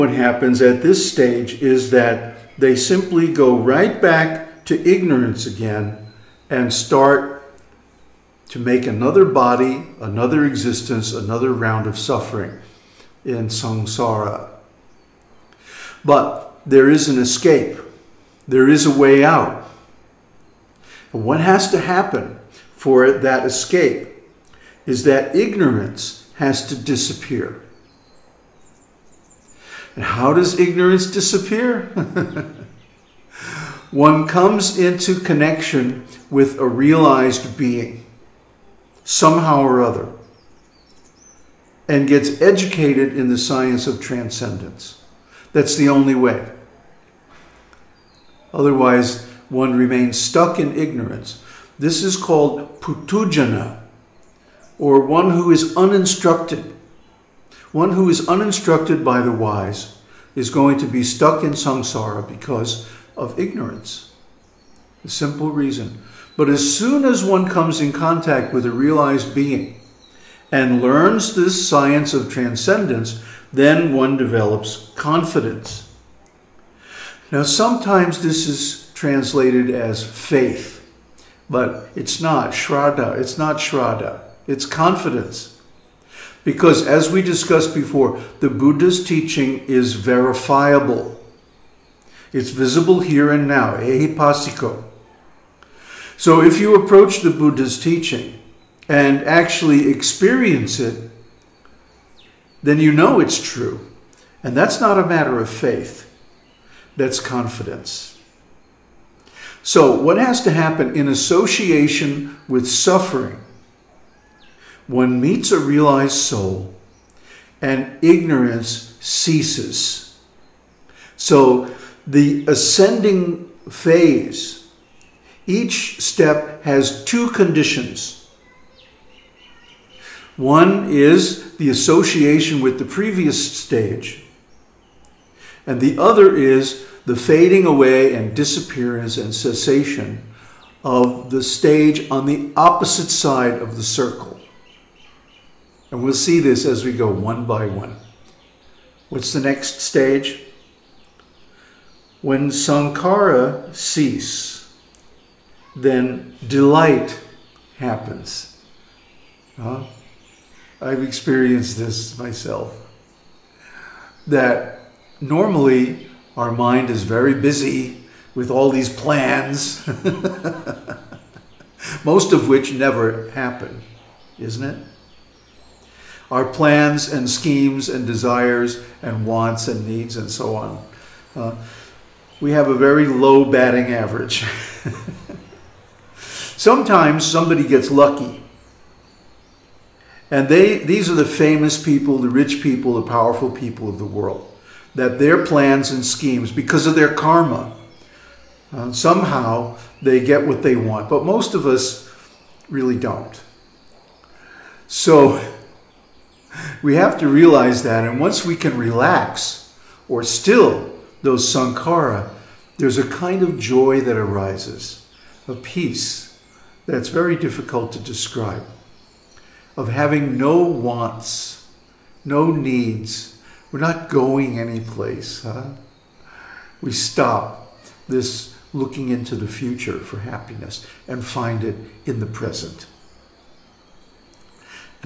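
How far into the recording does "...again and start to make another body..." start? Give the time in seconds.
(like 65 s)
5 s.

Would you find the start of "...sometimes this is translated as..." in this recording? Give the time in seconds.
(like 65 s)
77 s.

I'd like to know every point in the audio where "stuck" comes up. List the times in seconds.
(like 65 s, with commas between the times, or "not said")
50 s, 61 s.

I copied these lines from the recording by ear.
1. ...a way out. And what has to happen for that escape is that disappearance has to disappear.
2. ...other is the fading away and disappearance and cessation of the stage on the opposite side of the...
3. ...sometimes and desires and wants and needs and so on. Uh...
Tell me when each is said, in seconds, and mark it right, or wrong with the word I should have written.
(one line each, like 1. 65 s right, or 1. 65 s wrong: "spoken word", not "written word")
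1. 18 s wrong: "ignorance", not "disappearance"
2. 136 s right
3. 177 s wrong: "schemes", not "sometimes".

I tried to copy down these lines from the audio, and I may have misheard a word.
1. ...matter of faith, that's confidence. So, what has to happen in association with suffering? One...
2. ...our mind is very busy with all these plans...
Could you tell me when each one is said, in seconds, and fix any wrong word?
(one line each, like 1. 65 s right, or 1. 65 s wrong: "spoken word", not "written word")
1. 105 s right
2. 166 s right.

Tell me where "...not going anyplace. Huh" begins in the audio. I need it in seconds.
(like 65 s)
223 s.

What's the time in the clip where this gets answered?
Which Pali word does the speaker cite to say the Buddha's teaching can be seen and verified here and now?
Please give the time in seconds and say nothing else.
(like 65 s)
93 s.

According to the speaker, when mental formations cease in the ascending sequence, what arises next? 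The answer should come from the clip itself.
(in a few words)
delight.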